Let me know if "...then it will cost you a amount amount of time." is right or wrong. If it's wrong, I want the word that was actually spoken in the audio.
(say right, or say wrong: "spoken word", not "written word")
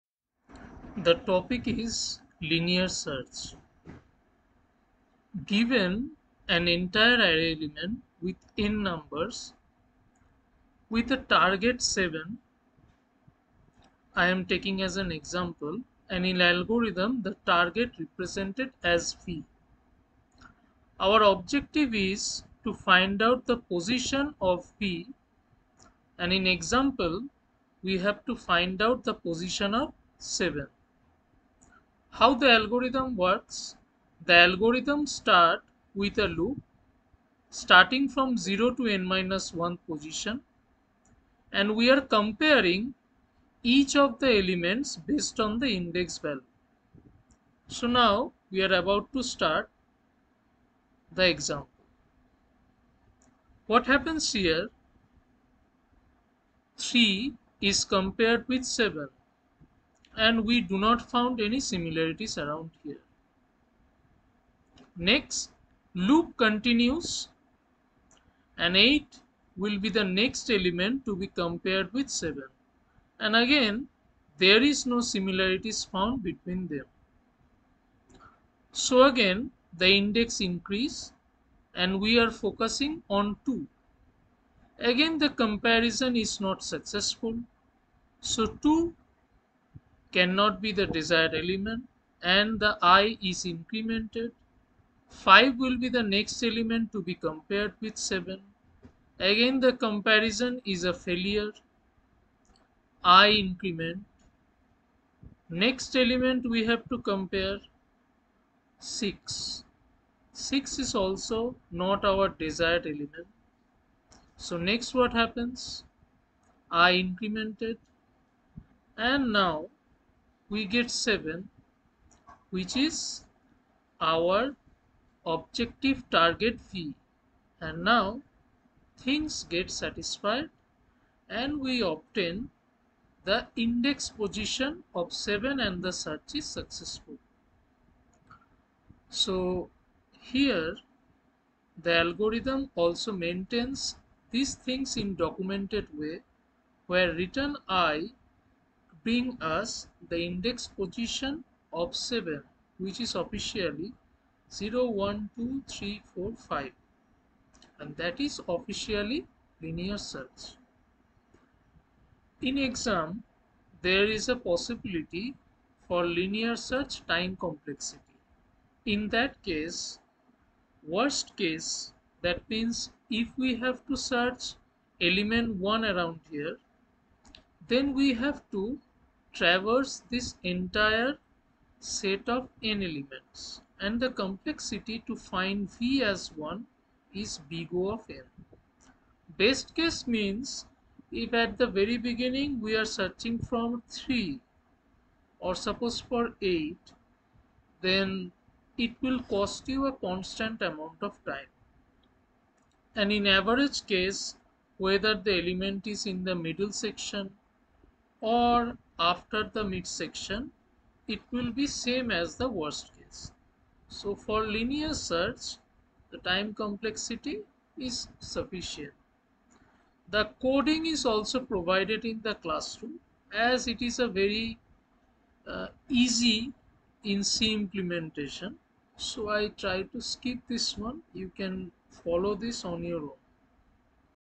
wrong: "constant", not "amount".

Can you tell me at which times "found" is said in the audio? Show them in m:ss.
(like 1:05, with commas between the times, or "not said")
1:01, 1:15.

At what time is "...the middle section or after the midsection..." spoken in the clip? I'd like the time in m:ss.
3:26.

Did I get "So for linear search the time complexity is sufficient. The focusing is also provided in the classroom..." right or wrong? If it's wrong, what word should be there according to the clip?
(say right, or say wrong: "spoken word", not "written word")
wrong: "coding", not "focusing".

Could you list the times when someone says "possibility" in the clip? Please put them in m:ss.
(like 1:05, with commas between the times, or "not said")
2:44.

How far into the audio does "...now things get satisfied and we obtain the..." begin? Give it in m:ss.
2:07.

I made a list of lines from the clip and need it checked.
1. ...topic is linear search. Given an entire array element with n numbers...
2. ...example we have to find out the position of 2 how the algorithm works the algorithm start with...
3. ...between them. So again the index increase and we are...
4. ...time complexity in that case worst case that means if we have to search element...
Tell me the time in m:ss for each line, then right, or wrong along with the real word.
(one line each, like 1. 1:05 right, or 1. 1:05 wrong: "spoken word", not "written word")
1. 0:01 right
2. 0:26 wrong: "7", not "2"
3. 1:16 right
4. 2:47 right.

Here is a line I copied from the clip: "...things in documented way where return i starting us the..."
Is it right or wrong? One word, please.
wrong.